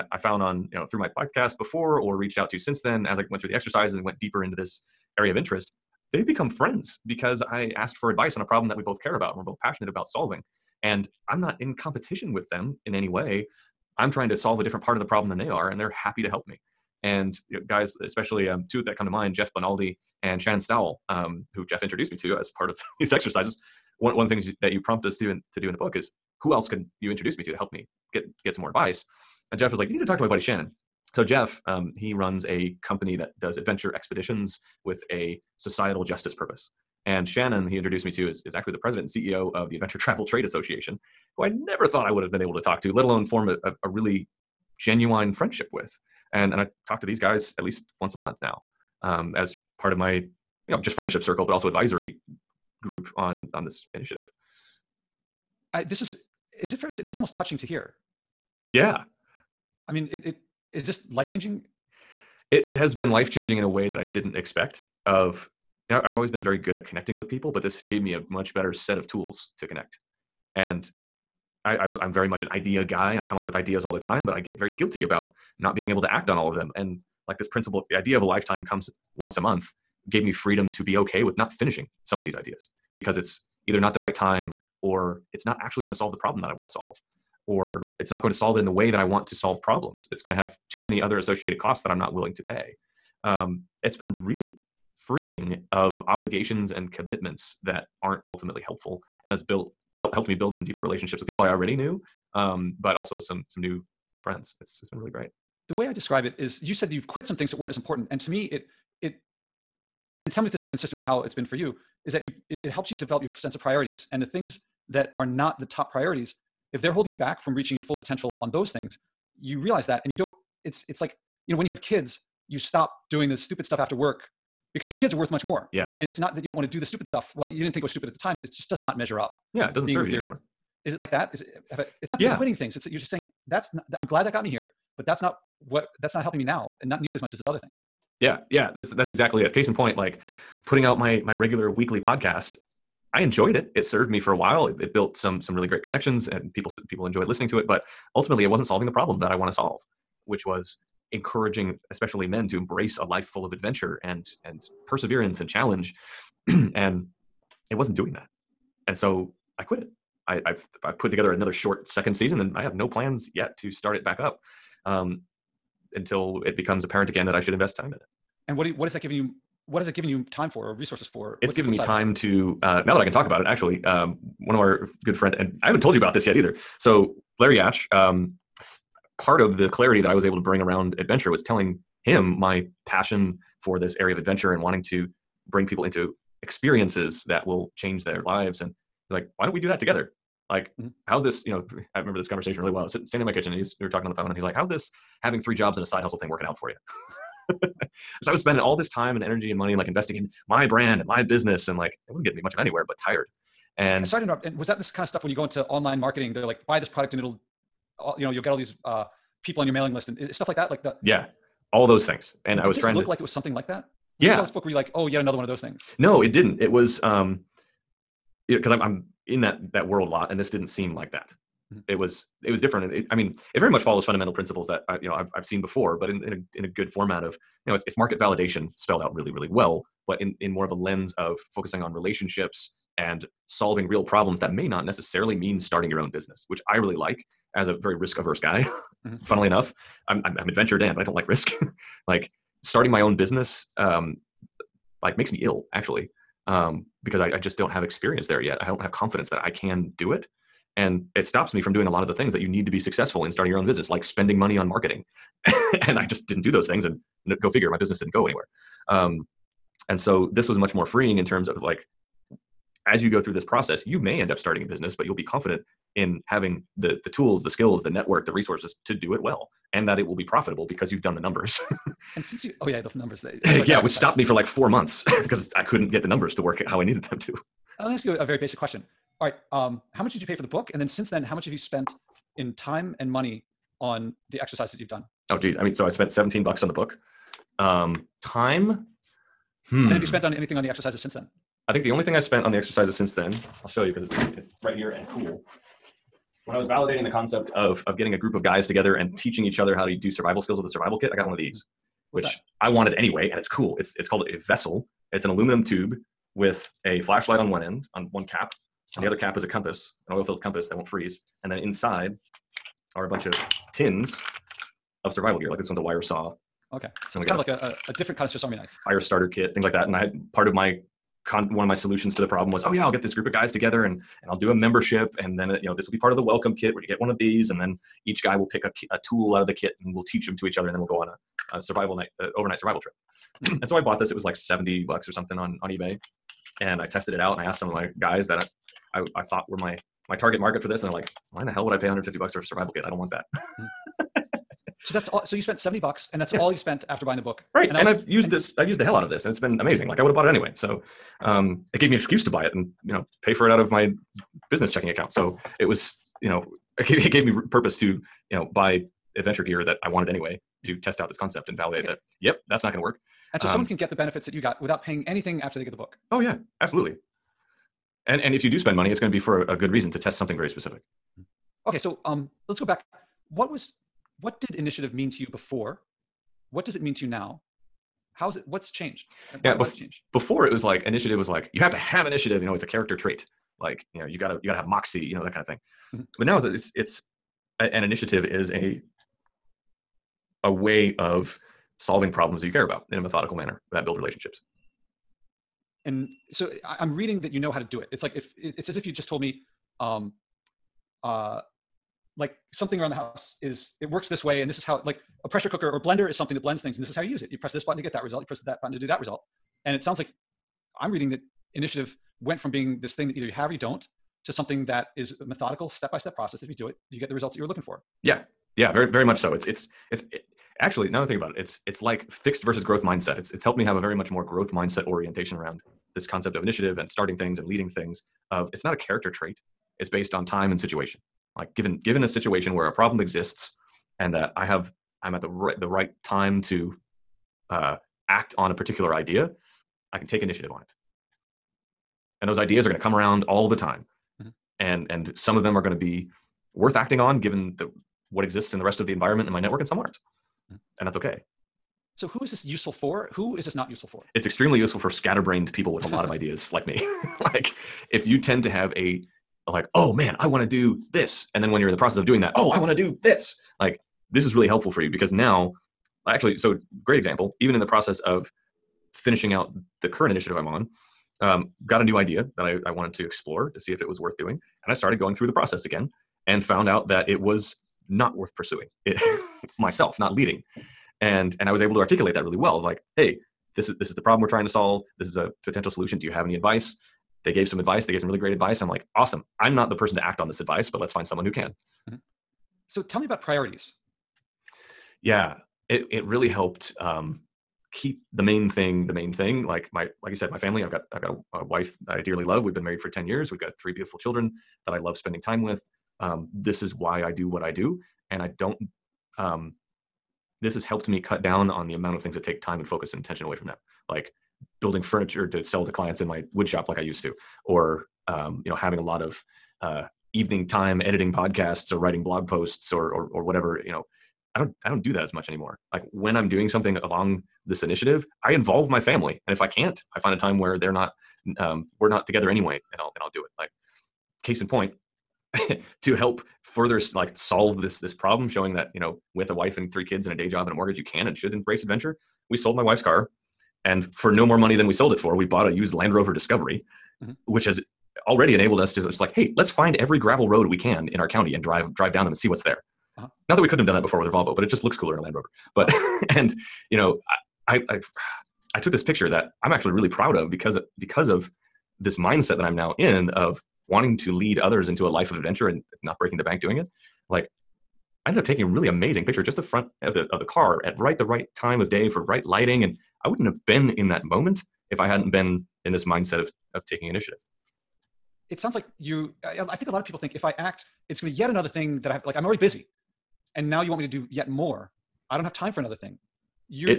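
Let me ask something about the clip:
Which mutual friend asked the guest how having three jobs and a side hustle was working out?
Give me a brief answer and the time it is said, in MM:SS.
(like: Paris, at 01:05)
Larry Yatch, at 02:57.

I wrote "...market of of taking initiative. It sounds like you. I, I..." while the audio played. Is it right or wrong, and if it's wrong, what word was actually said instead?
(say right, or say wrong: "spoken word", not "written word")
wrong: "mindset", not "market".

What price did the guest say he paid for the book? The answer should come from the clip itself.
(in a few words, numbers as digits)
17 dollars.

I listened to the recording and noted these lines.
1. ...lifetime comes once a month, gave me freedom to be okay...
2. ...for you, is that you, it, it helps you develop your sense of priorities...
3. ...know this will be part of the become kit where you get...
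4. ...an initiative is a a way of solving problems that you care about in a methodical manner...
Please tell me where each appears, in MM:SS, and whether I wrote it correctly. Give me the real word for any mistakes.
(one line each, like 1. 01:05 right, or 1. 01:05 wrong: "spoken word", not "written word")
1. 01:18 right
2. 01:51 right
3. 05:25 wrong: "welcome", not "become"
4. 06:27 right.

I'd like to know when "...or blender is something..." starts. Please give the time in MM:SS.
06:45.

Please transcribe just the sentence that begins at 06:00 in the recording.
test out this concept and validate okay.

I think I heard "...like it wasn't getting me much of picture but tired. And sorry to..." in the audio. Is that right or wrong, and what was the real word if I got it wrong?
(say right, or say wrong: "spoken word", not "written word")
wrong: "anywhere", not "picture".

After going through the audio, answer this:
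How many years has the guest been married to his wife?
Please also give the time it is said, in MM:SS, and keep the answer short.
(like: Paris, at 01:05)
10 years, at 08:22.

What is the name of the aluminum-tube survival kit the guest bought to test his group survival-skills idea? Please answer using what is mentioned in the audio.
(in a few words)
Vessel.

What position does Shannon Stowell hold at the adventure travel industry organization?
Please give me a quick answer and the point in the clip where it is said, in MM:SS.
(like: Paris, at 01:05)
President and CEO, at 00:38.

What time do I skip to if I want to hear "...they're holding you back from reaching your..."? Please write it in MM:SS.
01:56.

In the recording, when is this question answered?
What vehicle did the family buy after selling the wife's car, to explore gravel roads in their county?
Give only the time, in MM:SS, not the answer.
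09:05.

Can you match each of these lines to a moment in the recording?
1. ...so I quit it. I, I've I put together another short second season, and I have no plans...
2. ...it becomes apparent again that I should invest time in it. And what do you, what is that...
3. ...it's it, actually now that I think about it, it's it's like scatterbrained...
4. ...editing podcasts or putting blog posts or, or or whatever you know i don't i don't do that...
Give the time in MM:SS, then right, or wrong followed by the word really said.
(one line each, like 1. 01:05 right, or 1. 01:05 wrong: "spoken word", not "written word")
1. 02:38 right
2. 02:46 right
3. 06:59 wrong: "fixed", not "scatterbrained"
4. 08:40 wrong: "writing", not "putting".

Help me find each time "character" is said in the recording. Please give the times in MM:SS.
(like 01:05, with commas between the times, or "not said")
06:22, 07:08.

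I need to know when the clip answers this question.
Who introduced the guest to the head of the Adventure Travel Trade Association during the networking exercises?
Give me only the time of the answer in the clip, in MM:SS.
00:19.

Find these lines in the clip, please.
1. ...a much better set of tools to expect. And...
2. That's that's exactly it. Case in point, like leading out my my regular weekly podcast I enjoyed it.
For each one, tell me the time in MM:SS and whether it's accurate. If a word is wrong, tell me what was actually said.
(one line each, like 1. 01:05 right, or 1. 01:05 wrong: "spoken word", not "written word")
1. 01:08 wrong: "connect", not "expect"
2. 02:18 wrong: "putting", not "leading".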